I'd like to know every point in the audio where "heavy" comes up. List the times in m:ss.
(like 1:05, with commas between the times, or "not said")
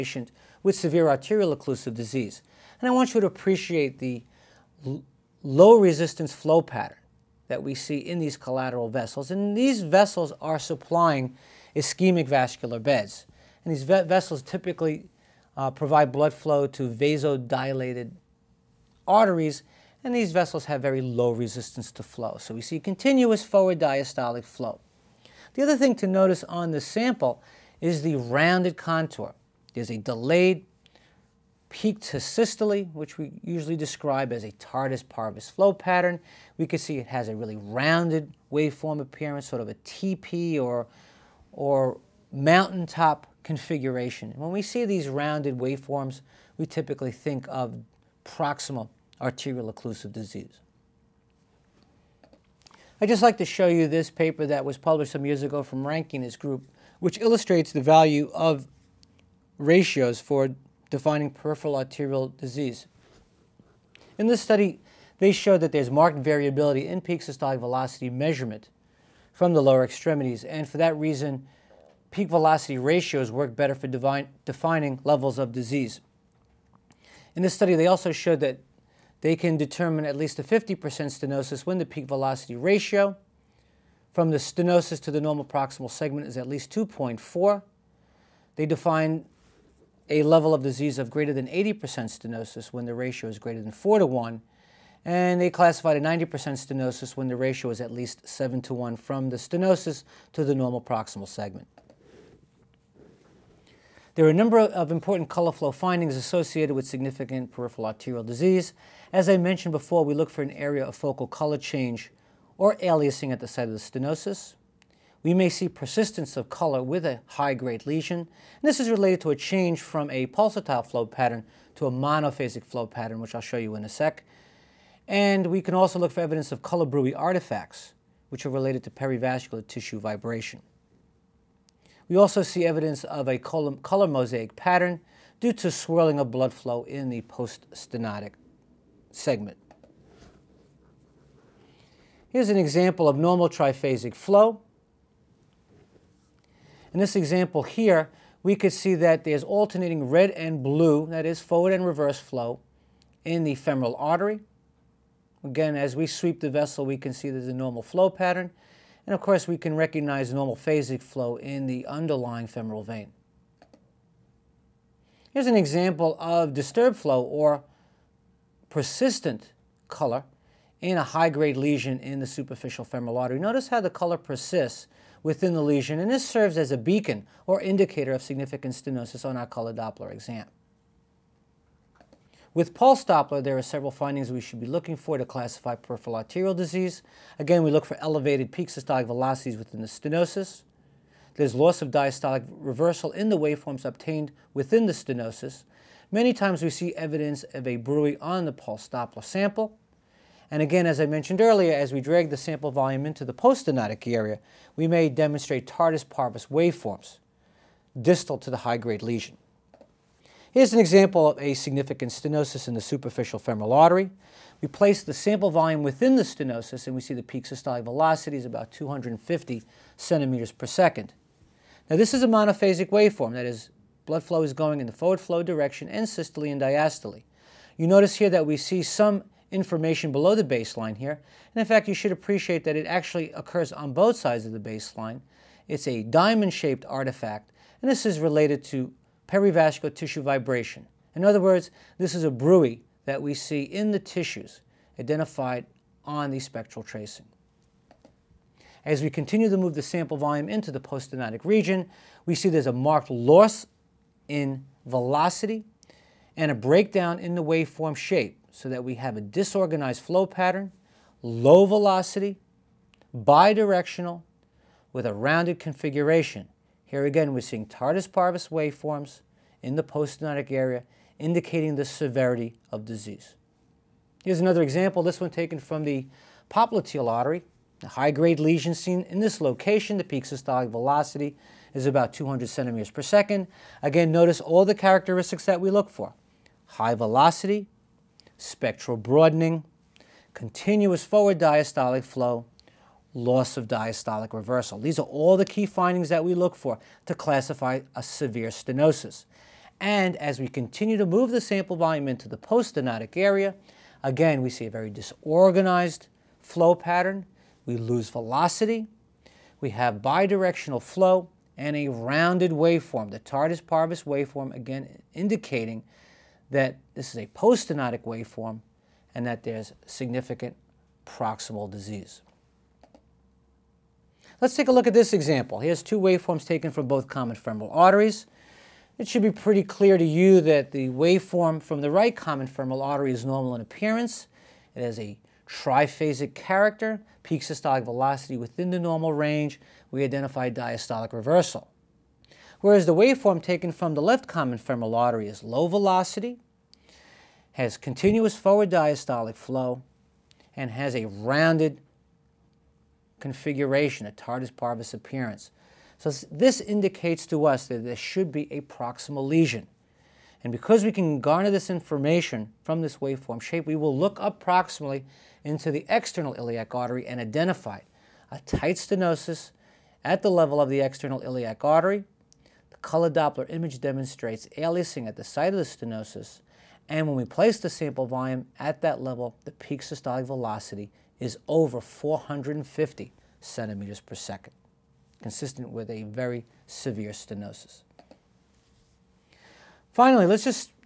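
not said.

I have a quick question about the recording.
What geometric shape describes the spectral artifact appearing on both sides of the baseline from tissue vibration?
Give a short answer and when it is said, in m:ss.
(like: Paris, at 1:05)
diamond-shaped, at 3:56.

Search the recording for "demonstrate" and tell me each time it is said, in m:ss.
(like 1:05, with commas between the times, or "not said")
3:25, 6:13.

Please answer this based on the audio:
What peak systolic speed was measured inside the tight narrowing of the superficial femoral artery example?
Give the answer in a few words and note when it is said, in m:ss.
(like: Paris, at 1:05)
250 cm/s, at 3:38.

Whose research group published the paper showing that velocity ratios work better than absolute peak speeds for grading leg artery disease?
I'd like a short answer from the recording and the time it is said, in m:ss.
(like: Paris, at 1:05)
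Rankin, at 0:55.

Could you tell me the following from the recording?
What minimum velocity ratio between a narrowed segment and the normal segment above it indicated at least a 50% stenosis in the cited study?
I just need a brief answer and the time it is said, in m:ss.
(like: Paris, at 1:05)
2.4, at 1:26.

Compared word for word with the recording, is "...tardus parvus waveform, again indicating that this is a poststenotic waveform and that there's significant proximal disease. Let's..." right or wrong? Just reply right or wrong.
right.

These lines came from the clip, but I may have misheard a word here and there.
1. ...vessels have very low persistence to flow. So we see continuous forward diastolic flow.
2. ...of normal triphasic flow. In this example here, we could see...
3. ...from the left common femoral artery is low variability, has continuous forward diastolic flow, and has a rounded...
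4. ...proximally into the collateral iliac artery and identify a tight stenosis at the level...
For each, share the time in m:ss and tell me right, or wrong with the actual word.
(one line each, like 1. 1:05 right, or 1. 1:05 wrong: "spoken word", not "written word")
1. 0:20 wrong: "resistance", not "persistence"
2. 2:23 right
3. 5:43 wrong: "velocity", not "variability"
4. 6:04 wrong: "external", not "collateral".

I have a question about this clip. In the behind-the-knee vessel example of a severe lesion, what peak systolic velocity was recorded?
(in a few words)
200 cm/s.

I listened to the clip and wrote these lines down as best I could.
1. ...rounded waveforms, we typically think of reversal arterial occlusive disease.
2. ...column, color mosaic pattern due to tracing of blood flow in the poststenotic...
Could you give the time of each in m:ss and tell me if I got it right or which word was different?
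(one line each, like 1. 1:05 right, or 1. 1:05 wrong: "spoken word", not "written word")
1. 0:45 wrong: "proximal", not "reversal"
2. 2:13 wrong: "swirling", not "tracing".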